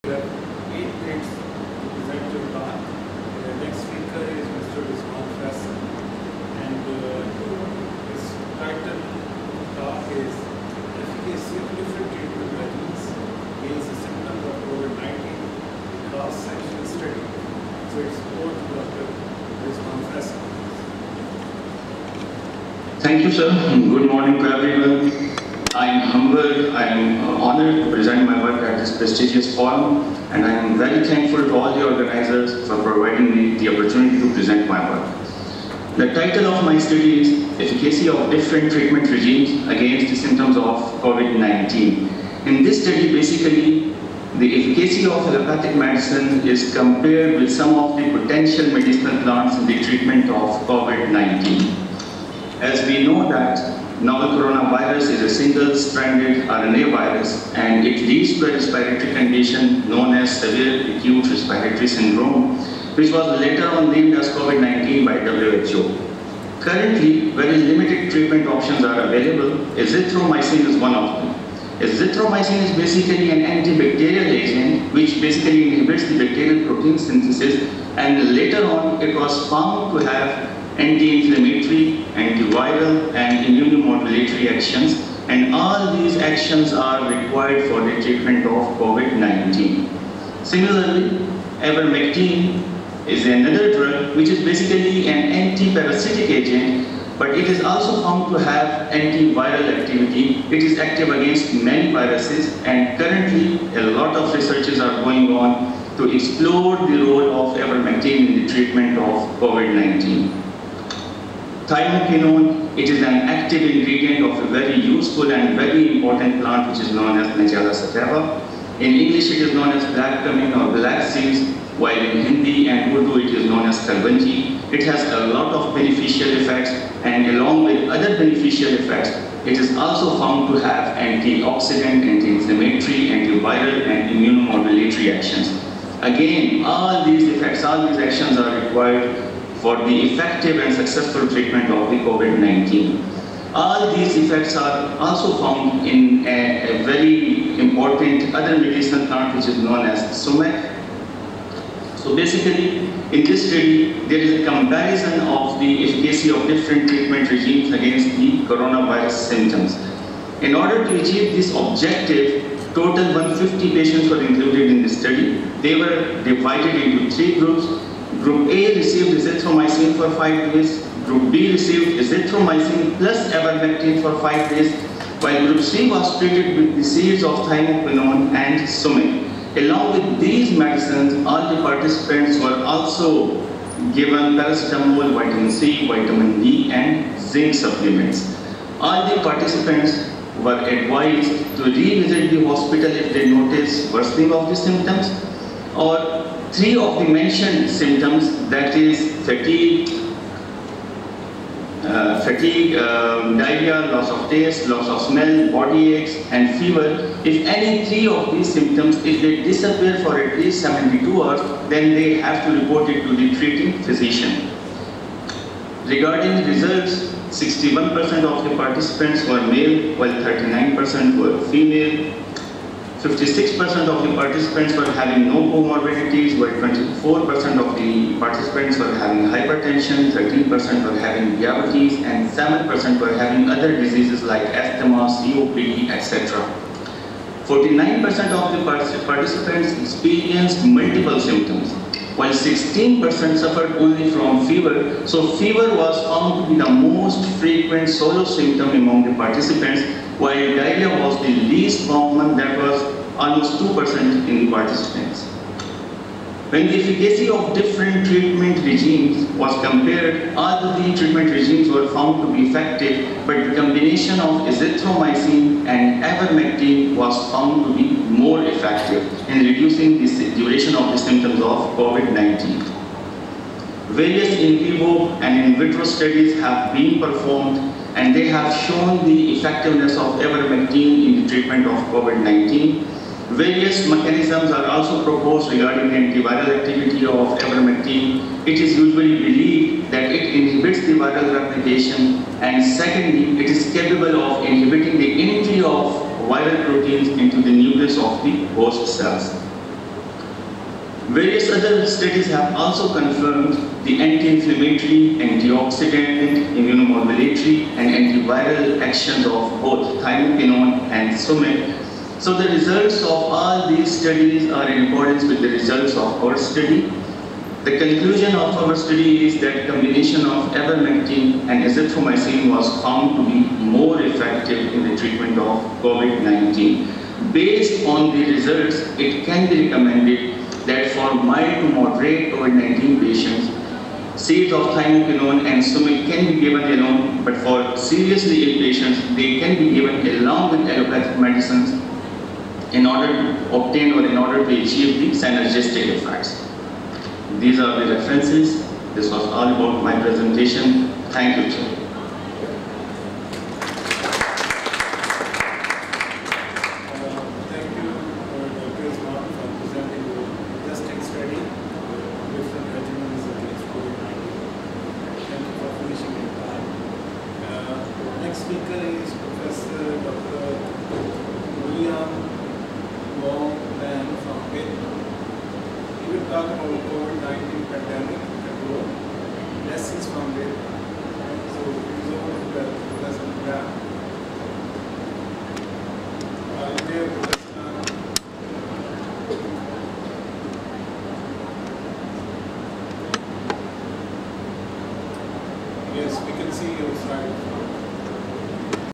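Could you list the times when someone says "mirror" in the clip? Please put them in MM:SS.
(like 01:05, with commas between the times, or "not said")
not said.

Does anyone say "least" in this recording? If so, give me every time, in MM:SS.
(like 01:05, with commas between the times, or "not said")
03:30, 04:11.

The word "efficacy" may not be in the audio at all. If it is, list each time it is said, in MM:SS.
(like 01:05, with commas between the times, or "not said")
00:37, 00:44, 02:35, 04:16.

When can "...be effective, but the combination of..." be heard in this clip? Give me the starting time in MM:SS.
04:22.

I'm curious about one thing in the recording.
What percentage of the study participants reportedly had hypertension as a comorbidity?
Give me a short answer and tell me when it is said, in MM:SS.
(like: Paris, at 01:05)
24%, at 03:46.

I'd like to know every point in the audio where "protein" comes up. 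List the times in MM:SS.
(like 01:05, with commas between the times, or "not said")
01:16, 04:56.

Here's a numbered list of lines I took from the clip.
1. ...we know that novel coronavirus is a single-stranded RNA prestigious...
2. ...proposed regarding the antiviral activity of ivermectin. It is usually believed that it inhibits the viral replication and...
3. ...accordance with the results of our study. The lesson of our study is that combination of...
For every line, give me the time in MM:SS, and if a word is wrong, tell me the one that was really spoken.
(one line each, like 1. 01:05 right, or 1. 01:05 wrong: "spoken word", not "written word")
1. 00:52 wrong: "virus", not "prestigious"
2. 04:45 right
3. 05:14 wrong: "conclusion", not "lesson".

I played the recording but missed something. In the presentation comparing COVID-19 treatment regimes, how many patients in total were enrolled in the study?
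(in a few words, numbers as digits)
150.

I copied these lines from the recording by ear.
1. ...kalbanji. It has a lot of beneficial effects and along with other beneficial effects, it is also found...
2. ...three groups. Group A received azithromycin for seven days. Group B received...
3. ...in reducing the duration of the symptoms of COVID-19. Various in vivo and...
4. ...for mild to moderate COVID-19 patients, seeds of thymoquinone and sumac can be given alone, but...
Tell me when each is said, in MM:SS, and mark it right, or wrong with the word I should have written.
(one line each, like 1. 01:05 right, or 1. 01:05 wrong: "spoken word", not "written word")
1. 02:03 right
2. 02:47 wrong: "five", not "seven"
3. 04:29 right
4. 05:30 right.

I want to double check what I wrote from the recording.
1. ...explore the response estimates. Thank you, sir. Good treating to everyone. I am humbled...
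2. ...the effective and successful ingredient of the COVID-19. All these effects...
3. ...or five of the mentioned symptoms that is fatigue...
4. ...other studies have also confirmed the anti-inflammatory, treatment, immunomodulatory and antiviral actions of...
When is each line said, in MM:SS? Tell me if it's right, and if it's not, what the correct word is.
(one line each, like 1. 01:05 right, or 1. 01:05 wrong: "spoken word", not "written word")
1. 00:18 wrong: "morning", not "treating"
2. 02:19 wrong: "treatment", not "ingredient"
3. 03:15 wrong: "three", not "five"
4. 05:01 wrong: "antioxidant", not "treatment".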